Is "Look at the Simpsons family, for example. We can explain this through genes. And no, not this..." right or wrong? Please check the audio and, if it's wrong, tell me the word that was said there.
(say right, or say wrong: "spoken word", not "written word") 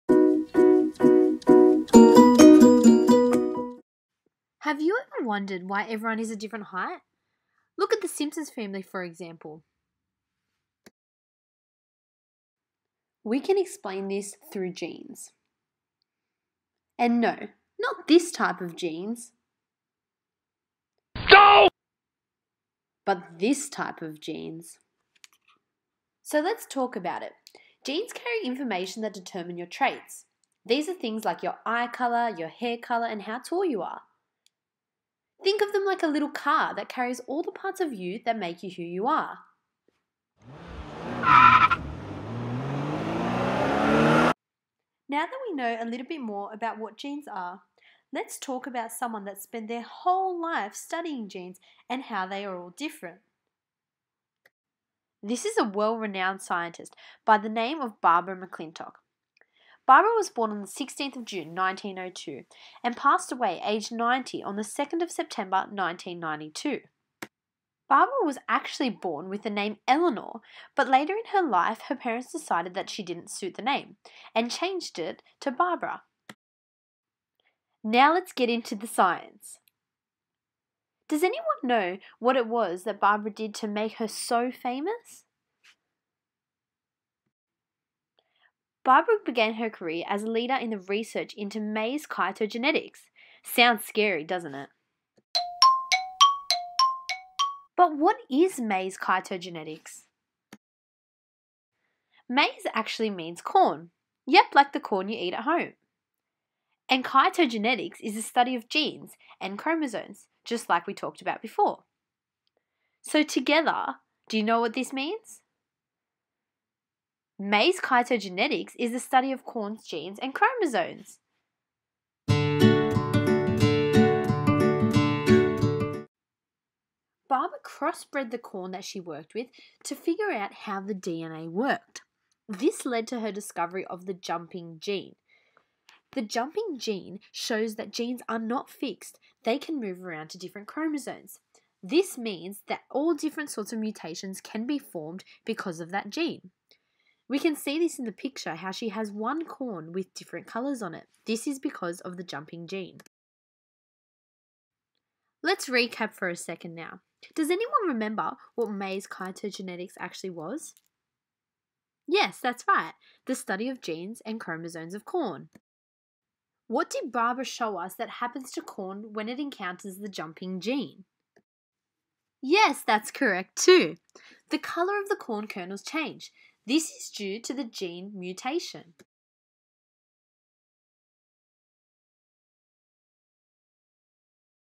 right.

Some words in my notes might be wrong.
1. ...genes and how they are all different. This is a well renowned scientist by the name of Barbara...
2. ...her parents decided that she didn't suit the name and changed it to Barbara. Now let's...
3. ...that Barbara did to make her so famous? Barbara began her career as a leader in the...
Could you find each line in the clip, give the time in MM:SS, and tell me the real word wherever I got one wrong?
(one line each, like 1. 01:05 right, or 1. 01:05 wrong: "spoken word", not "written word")
1. 00:51 right
2. 01:11 right
3. 01:22 right.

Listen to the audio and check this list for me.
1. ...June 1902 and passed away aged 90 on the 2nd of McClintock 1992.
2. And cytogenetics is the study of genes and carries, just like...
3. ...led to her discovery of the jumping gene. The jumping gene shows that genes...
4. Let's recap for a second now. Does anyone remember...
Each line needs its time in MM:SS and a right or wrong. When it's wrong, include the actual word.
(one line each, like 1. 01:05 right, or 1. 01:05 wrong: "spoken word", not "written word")
1. 01:01 wrong: "September", not "McClintock"
2. 01:46 wrong: "chromosomes", not "carries"
3. 02:12 right
4. 02:35 right.